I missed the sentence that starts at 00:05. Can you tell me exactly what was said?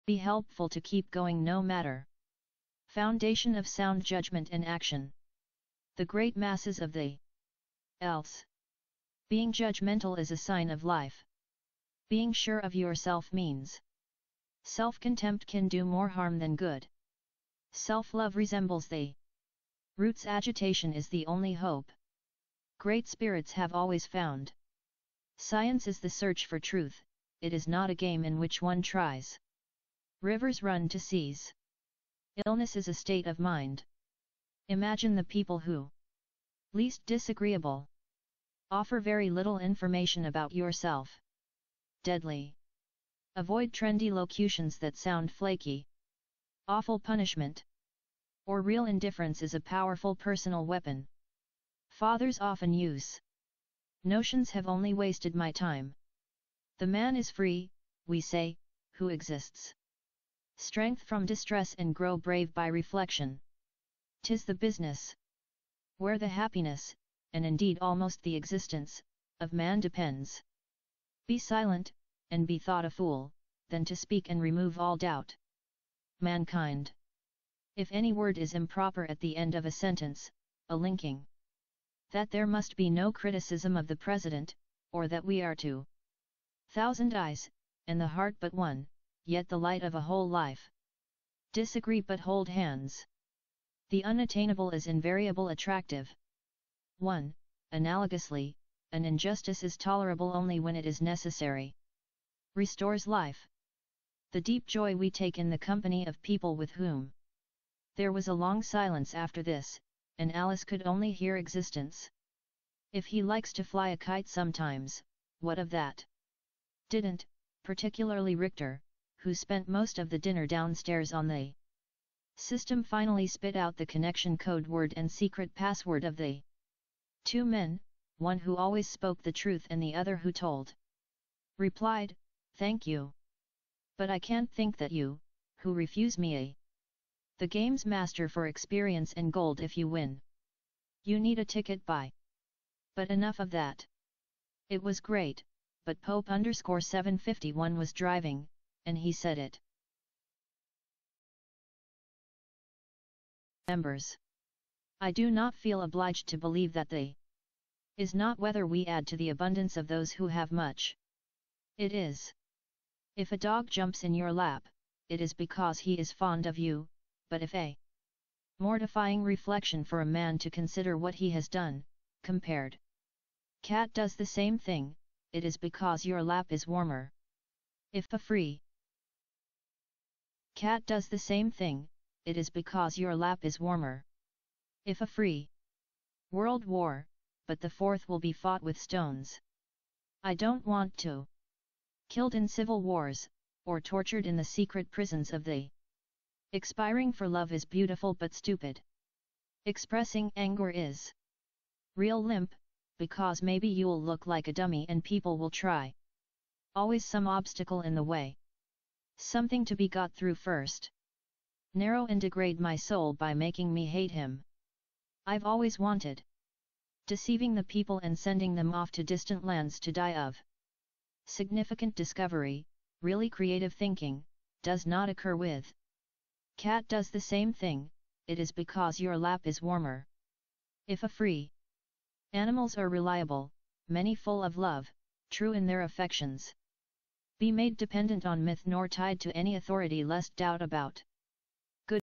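The great masses of the else.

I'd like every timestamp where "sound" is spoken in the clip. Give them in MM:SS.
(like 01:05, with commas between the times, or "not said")
00:03, 00:44.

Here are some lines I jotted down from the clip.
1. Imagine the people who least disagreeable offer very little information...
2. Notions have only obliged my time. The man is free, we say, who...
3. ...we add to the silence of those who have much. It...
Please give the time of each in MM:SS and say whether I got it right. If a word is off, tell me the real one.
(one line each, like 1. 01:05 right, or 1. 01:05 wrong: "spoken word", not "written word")
1. 00:34 right
2. 00:54 wrong: "wasted", not "obliged"
3. 02:38 wrong: "abundance", not "silence".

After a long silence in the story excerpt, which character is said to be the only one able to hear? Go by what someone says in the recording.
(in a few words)
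Alice.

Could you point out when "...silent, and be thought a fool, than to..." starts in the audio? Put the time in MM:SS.
01:11.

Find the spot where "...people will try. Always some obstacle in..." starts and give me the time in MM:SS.
03:25.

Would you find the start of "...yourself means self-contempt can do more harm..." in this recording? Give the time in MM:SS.
00:12.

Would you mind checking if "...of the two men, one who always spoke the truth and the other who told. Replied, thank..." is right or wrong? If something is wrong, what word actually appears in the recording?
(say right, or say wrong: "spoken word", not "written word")
right.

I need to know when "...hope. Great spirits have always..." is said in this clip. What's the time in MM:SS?
00:21.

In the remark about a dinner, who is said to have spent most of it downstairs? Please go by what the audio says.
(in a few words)
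Richter.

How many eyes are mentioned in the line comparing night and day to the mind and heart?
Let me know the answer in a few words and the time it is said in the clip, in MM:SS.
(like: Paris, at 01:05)
2000, at 01:25.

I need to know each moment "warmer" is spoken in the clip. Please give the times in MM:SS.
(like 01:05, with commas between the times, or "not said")
02:56, 03:03, 03:49.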